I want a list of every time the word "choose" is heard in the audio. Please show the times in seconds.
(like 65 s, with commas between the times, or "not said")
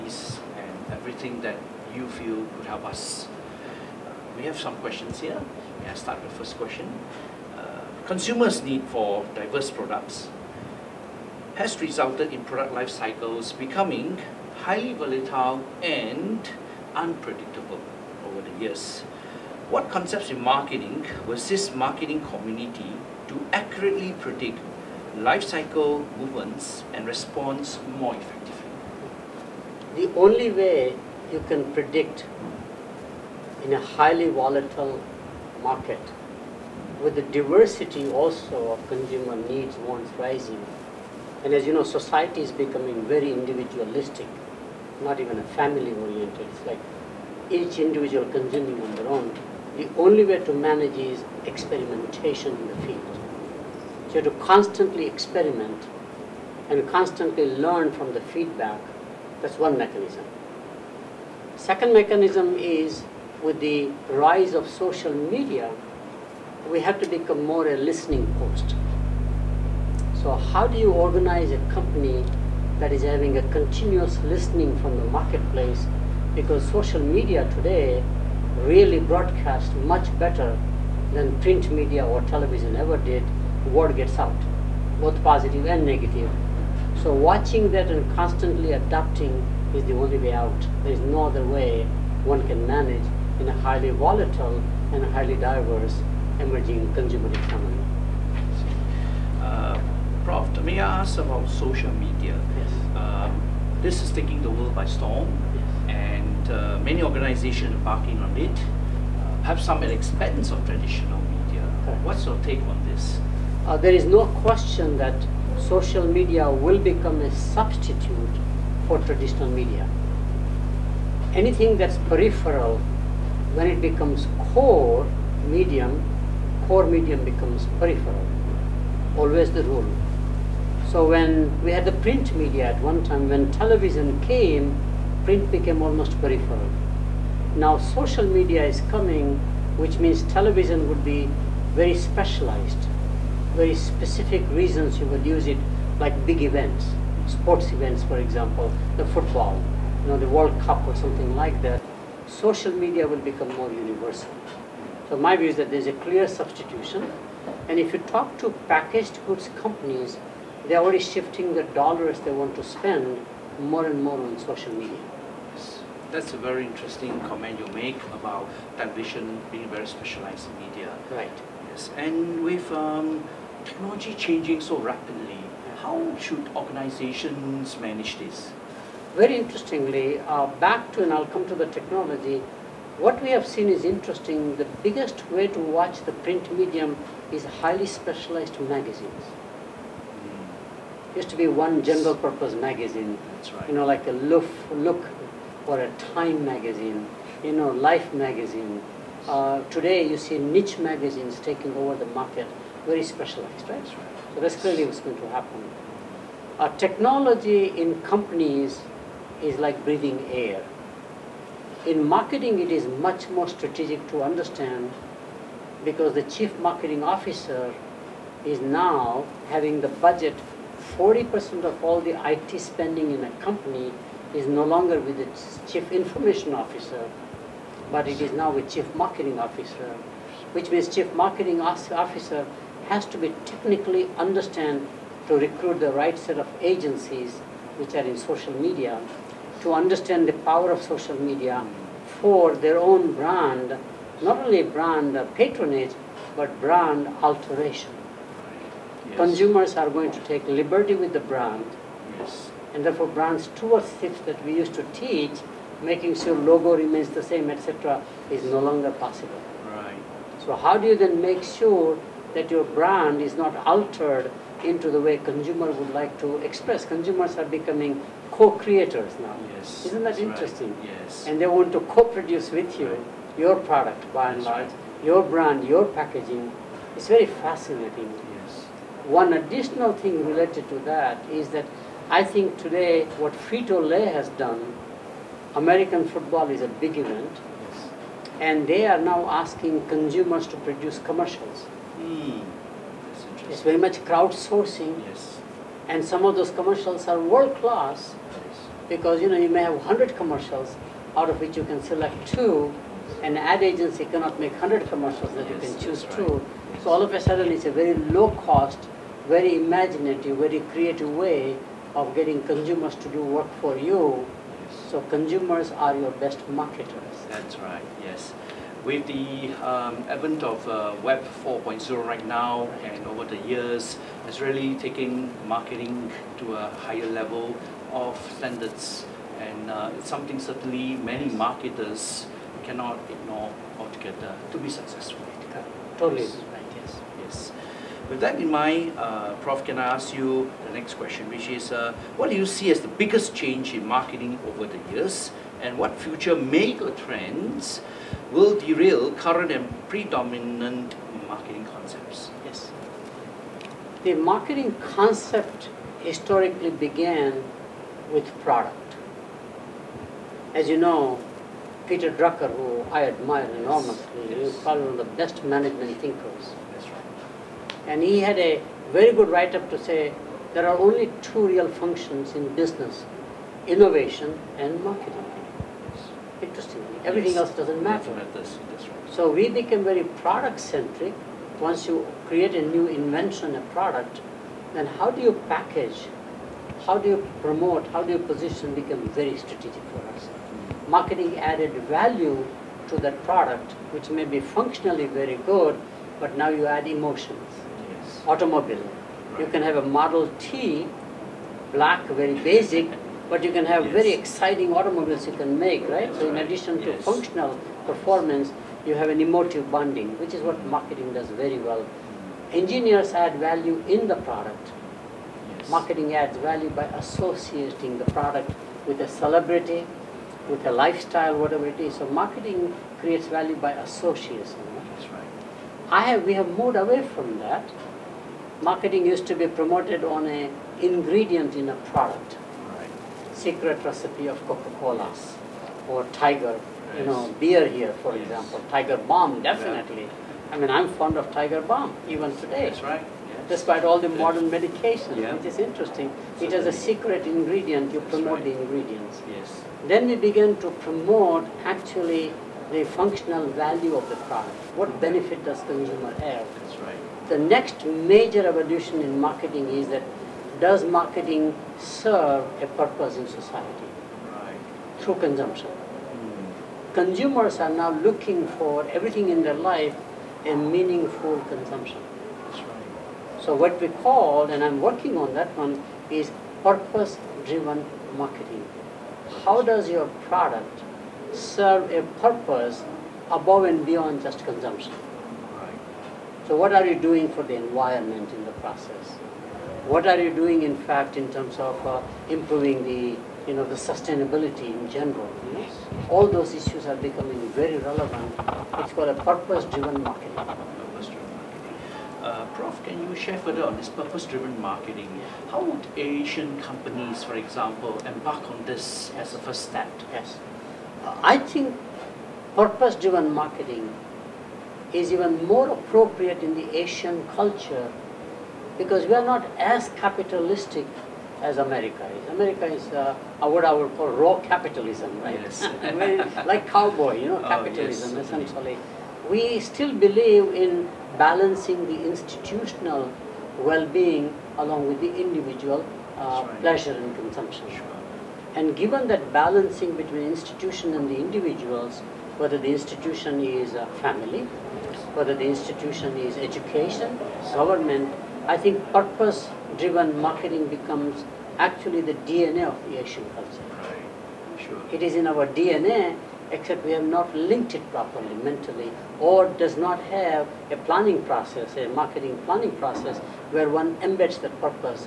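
305 s.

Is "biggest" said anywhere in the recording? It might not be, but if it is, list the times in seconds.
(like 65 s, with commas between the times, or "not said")
184 s, 342 s.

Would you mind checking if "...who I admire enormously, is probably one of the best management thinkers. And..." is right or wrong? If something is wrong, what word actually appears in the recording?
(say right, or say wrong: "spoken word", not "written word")
right.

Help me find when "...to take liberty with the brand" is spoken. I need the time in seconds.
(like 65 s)
250 s.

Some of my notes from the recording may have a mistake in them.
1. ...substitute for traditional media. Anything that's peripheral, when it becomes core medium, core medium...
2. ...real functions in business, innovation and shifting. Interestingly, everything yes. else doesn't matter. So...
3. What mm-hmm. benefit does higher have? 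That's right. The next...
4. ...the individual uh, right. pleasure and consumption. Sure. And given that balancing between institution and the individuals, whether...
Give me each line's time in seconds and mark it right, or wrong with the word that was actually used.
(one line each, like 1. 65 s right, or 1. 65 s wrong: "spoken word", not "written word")
1. 117 s right
2. 371 s wrong: "marketing", not "shifting"
3. 454 s wrong: "consumer", not "higher"
4. 534 s right.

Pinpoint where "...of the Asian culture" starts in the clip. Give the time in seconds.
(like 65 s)
552 s.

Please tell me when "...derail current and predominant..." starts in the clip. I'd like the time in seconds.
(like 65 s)
348 s.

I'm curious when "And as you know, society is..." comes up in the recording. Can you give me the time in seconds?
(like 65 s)
41 s.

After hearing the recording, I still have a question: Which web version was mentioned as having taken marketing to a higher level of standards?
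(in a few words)
Web 4.0.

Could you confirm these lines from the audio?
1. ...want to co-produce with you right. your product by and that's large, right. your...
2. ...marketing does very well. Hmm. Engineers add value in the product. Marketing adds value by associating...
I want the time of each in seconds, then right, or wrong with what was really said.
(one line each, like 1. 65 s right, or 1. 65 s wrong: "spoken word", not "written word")
1. 271 s right
2. 410 s right.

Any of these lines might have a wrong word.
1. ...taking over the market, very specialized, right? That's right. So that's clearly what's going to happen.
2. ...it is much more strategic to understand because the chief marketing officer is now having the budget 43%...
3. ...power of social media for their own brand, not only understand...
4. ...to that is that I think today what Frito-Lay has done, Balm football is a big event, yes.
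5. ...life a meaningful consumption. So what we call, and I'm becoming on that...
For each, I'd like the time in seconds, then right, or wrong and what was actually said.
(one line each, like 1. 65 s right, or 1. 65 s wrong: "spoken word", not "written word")
1. 201 s right
2. 212 s wrong: "40", not "43"
3. 240 s wrong: "brand", not "understand"
4. 280 s wrong: "American", not "Balm"
5. 469 s wrong: "working", not "becoming".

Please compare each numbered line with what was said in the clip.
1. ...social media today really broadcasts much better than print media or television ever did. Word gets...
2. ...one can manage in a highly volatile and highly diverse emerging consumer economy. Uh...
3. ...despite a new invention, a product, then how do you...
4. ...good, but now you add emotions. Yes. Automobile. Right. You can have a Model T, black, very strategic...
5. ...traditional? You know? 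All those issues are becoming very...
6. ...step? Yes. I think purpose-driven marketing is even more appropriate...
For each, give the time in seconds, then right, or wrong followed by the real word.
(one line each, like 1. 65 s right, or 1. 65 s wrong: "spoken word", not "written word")
1. 76 s right
2. 92 s right
3. 382 s wrong: "create", not "despite"
4. 395 s wrong: "basic", not "strategic"
5. 494 s wrong: "general", not "traditional"
6. 509 s right.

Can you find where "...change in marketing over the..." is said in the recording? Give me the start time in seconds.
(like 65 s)
343 s.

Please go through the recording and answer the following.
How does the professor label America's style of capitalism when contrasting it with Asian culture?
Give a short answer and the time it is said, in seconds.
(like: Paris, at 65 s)
raw capitalism, at 524 s.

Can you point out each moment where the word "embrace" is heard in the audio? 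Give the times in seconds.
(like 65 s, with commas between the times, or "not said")
not said.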